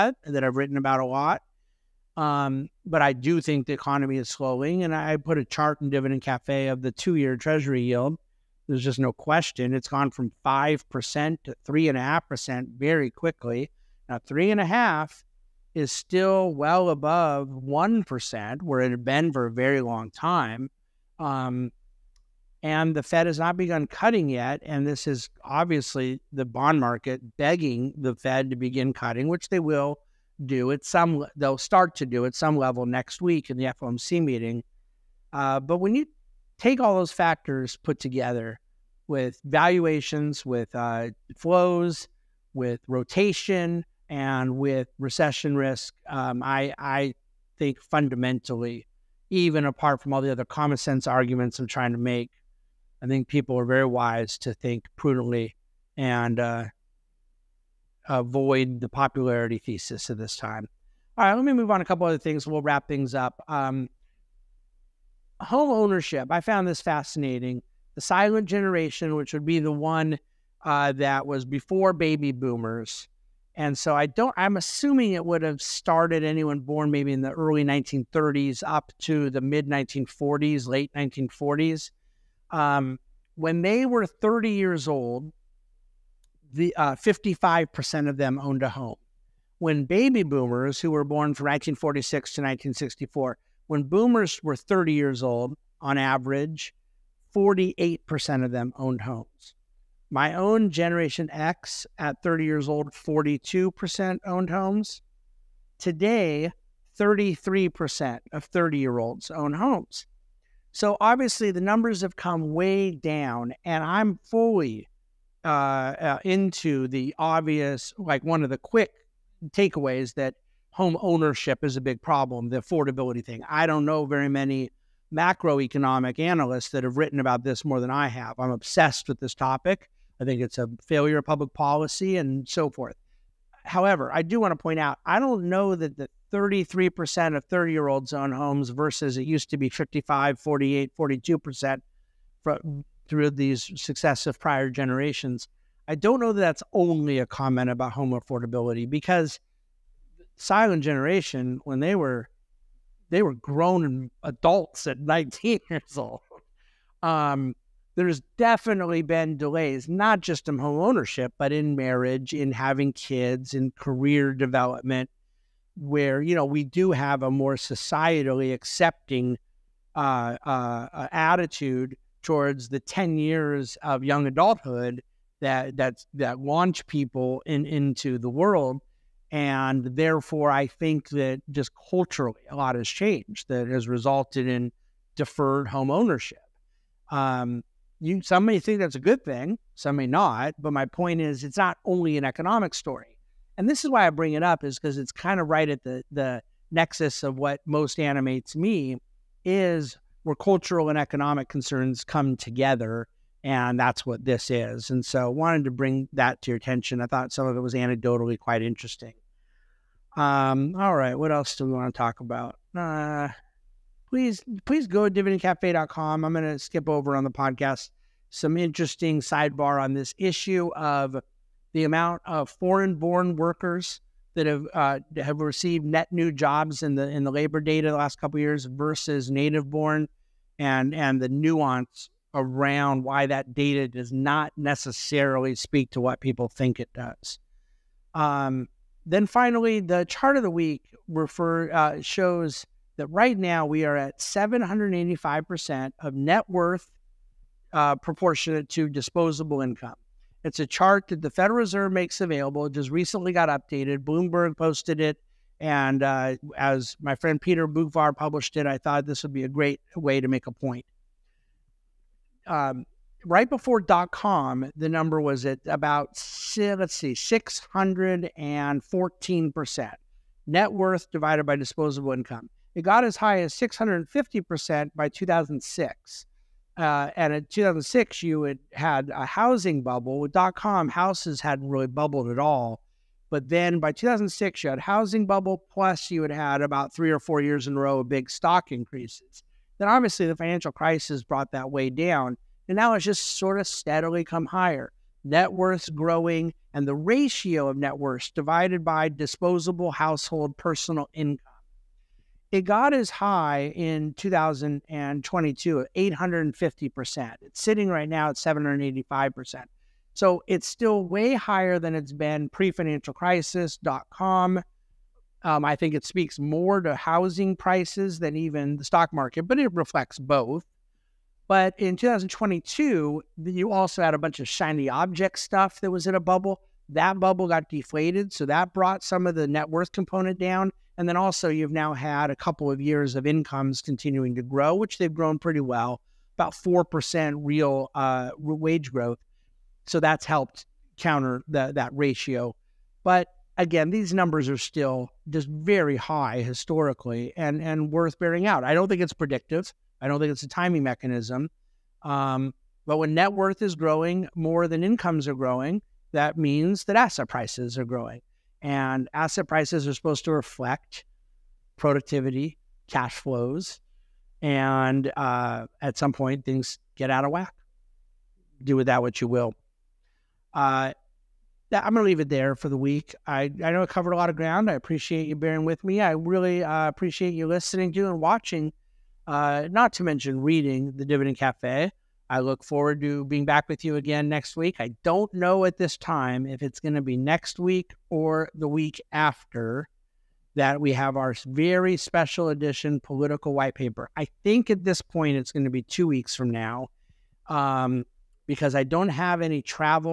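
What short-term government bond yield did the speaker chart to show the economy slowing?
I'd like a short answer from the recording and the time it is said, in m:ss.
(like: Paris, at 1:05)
Two year Treasury yield, at 0:06.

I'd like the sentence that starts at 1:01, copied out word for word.
All right, let me move on a couple other things.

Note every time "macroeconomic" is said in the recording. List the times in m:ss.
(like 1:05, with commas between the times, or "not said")
2:05.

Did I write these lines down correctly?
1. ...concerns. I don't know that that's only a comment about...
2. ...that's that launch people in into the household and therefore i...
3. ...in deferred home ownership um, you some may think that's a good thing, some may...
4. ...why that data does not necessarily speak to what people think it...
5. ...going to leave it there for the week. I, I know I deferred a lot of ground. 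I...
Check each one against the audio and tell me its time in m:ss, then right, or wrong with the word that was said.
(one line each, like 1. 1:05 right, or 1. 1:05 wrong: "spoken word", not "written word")
1. 2:24 wrong: "generations", not "concerns"
2. 2:55 wrong: "world", not "household"
3. 3:04 right
4. 3:53 right
5. 6:11 wrong: "covered", not "deferred".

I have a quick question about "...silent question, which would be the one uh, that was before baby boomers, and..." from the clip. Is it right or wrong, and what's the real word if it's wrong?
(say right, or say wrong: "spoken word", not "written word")
wrong: "generation", not "question".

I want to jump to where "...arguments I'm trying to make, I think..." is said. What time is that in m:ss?
0:51.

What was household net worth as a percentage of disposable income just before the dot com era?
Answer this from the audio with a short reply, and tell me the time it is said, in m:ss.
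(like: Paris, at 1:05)
614%, at 4:27.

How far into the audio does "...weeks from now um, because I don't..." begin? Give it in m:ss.
6:36.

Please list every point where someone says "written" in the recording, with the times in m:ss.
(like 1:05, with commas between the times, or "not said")
0:00, 2:06.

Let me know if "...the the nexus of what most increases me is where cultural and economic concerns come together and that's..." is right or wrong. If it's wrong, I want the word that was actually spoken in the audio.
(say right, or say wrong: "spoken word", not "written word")
wrong: "animates", not "increases".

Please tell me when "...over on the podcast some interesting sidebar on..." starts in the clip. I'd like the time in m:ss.
3:36.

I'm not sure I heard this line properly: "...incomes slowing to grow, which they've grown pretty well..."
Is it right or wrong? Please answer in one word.
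wrong.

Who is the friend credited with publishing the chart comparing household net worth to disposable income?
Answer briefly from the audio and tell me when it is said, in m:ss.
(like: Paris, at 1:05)
Peter Boockvar, at 4:17.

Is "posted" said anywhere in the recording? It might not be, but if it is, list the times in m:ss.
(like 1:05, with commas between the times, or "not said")
4:14.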